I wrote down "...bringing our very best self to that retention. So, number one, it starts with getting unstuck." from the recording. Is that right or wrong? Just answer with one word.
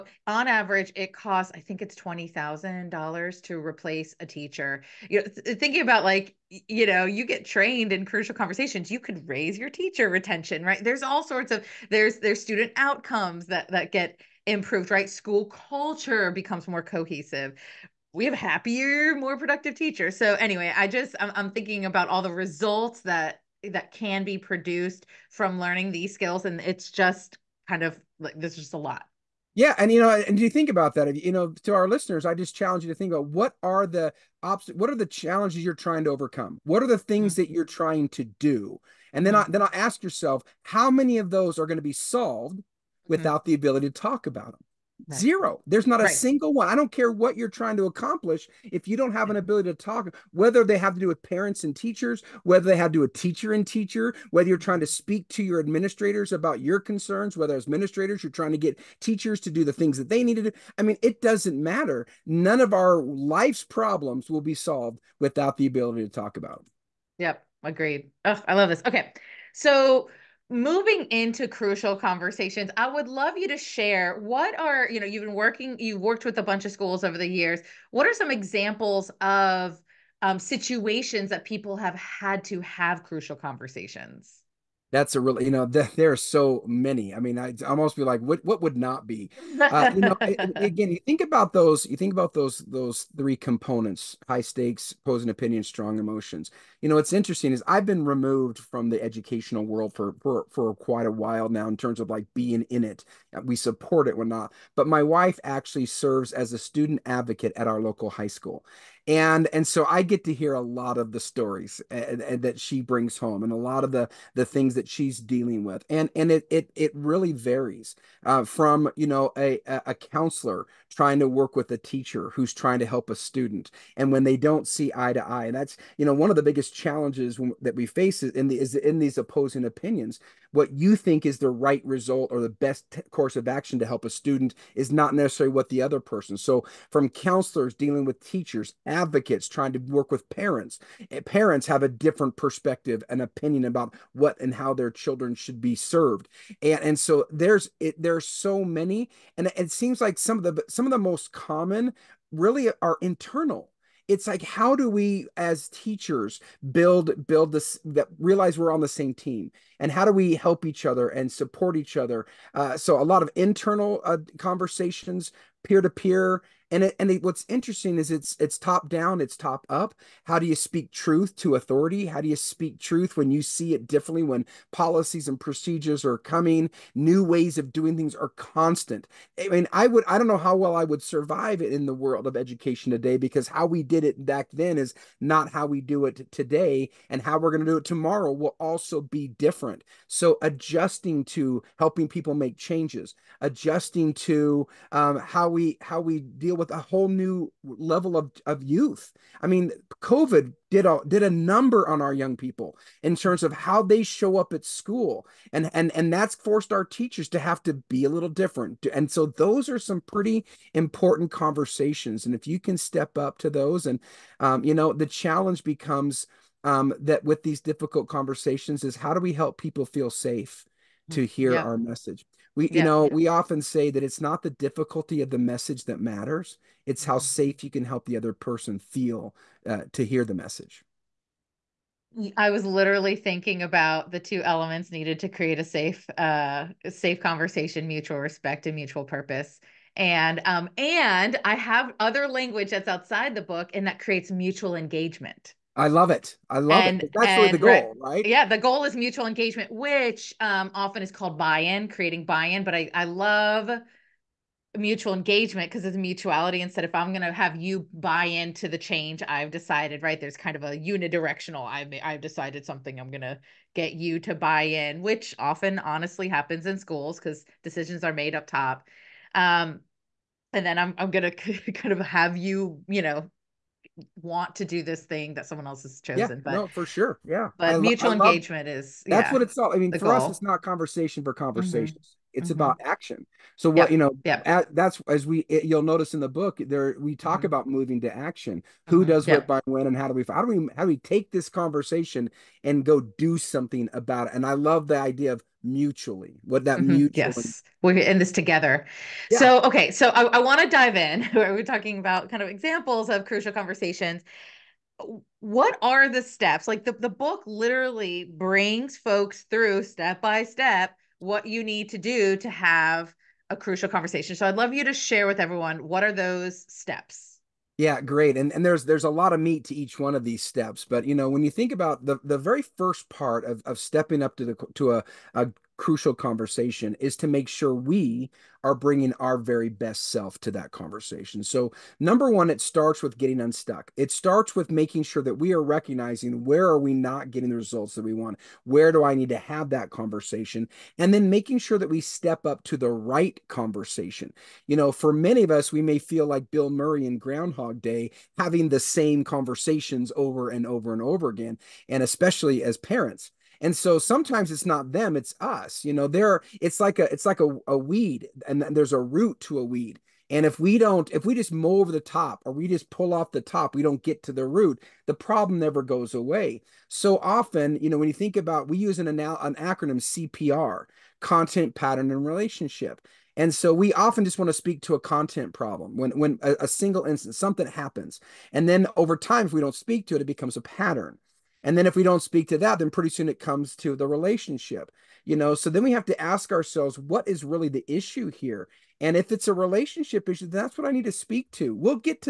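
wrong.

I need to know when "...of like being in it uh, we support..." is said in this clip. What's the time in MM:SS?
01:41.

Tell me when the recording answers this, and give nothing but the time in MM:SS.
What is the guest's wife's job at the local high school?
01:46.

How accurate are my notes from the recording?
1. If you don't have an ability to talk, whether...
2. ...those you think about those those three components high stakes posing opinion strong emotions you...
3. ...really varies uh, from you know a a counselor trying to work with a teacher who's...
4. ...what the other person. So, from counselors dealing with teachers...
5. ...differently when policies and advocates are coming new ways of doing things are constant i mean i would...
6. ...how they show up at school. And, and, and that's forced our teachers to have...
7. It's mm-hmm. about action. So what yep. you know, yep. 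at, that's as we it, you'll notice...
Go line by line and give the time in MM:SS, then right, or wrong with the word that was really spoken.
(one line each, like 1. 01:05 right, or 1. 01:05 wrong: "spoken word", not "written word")
1. 00:48 right
2. 01:31 right
3. 01:56 right
4. 02:15 right
5. 02:53 wrong: "procedures", not "advocates"
6. 03:23 right
7. 04:42 right.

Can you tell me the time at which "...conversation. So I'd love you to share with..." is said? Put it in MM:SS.
05:13.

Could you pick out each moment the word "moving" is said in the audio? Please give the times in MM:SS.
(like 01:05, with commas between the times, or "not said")
01:10, 04:47.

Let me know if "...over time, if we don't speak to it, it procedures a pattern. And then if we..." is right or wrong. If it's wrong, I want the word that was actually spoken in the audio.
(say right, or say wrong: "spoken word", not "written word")
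wrong: "becomes", not "procedures".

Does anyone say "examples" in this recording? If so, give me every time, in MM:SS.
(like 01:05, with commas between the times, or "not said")
01:18, 05:02.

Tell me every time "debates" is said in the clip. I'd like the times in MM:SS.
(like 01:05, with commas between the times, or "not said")
not said.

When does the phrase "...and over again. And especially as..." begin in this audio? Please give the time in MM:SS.
05:50.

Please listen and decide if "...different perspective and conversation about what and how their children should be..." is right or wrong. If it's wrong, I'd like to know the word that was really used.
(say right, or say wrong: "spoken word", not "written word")
wrong: "opinion", not "conversation".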